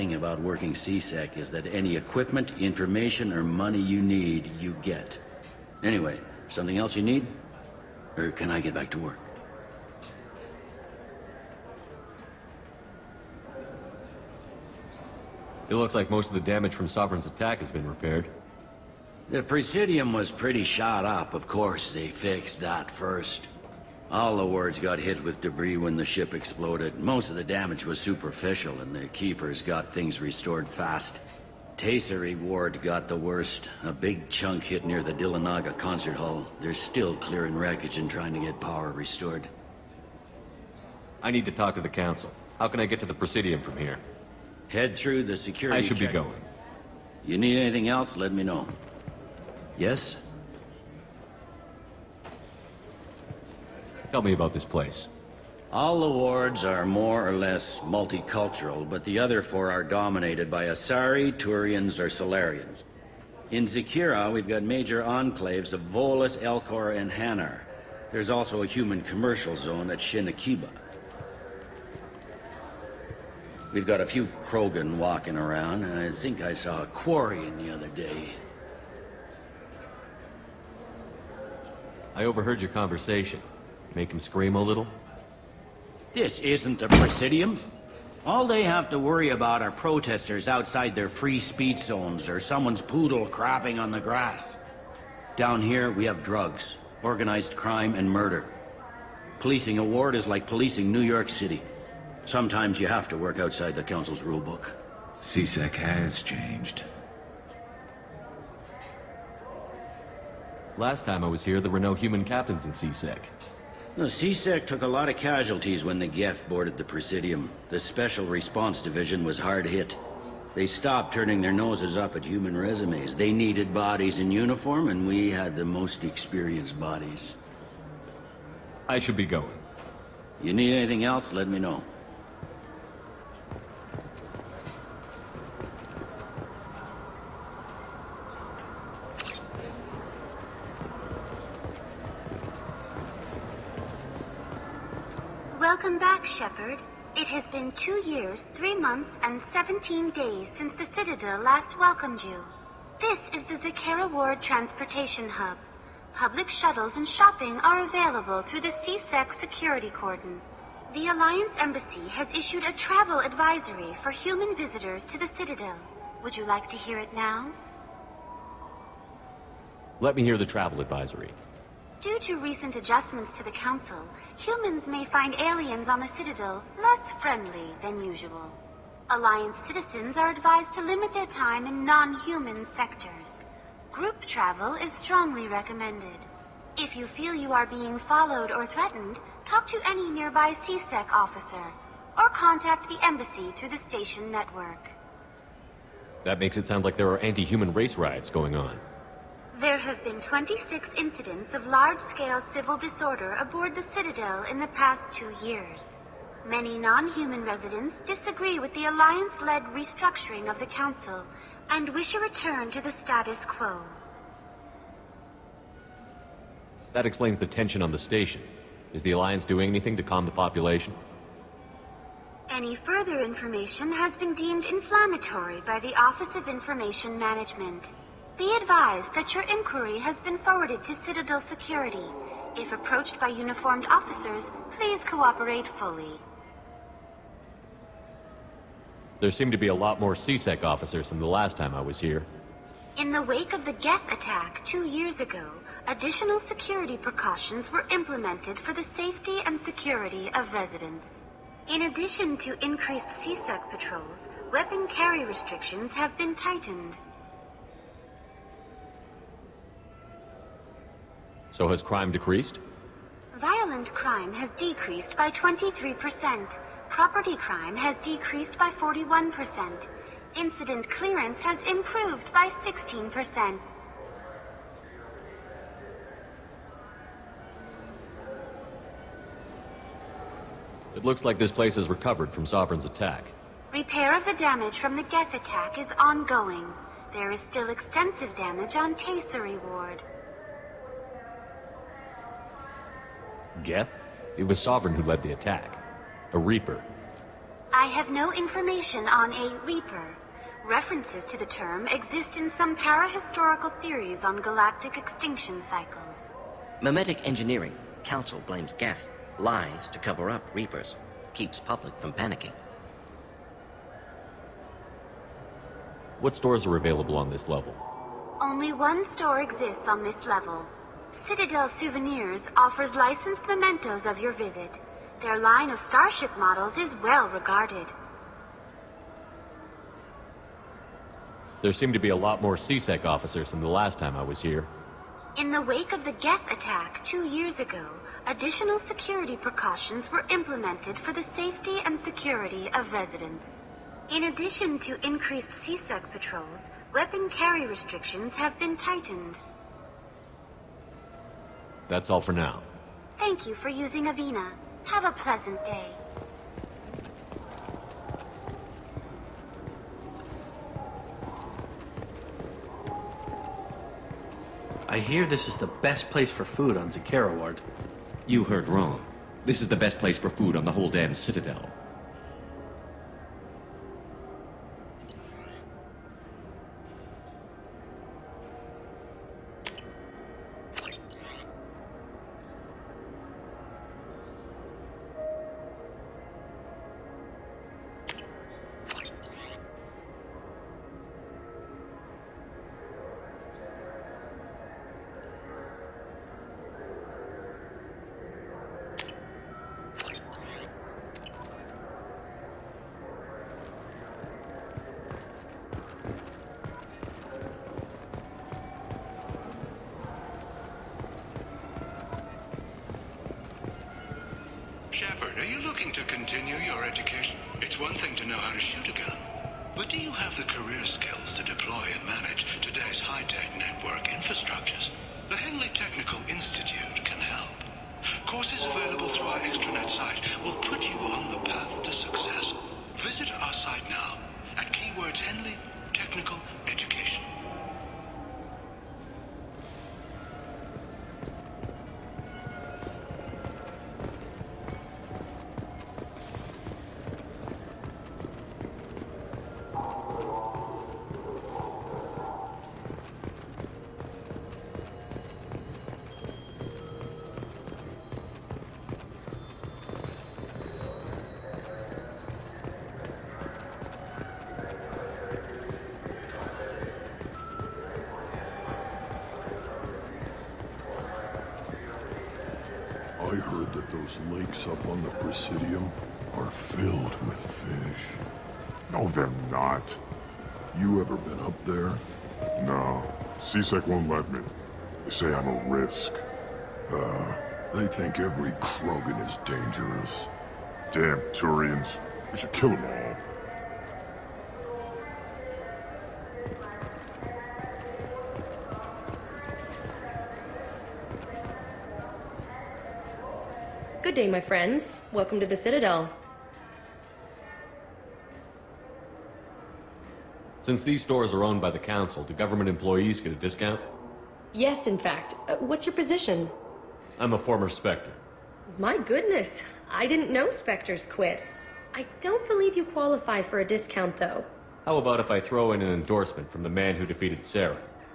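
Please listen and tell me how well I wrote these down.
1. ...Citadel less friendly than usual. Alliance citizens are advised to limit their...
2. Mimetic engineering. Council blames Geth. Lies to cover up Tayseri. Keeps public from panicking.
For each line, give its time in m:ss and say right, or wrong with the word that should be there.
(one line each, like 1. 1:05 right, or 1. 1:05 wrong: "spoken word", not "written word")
1. 2:56 right
2. 5:06 wrong: "Reapers", not "Tayseri".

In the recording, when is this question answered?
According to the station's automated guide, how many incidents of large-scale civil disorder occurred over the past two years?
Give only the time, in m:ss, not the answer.
3:20.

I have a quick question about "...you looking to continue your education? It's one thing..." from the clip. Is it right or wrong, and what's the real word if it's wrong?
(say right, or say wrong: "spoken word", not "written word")
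right.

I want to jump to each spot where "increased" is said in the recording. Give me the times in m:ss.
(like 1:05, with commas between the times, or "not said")
4:12, 5:45.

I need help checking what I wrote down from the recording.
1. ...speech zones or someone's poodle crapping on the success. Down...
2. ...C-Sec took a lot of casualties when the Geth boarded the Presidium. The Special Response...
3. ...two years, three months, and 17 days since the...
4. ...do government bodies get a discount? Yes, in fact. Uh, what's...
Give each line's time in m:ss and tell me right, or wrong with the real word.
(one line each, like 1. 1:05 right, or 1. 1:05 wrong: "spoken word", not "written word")
1. 1:31 wrong: "grass", not "success"
2. 1:54 right
3. 2:27 right
4. 8:32 wrong: "employees", not "bodies".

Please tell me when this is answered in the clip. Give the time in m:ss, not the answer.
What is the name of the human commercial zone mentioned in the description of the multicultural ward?
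1:09.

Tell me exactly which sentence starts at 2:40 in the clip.
The Alliance Embassy has issued a travel advisory for human visitors to the Citadel.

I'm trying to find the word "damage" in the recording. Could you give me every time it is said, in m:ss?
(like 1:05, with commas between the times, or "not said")
0:16, 0:27, 4:44, 4:48.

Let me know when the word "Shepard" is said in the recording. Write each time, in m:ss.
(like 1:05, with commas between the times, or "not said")
2:26, 6:54.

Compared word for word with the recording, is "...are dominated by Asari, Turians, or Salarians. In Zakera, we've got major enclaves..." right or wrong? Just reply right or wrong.
right.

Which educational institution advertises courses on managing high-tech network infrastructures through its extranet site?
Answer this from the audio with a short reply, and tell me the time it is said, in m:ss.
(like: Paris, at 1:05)
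Henley Technical Institute, at 7:05.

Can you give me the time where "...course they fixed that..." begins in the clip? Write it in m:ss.
0:21.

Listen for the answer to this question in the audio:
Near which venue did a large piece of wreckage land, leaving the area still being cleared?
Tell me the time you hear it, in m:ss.
0:35.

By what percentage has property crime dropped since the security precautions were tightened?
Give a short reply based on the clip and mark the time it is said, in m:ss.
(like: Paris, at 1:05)
41%, at 4:28.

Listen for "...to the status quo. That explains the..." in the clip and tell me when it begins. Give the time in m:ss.
3:32.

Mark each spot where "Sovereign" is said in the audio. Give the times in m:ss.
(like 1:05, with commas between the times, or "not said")
0:16, 4:42, 4:54.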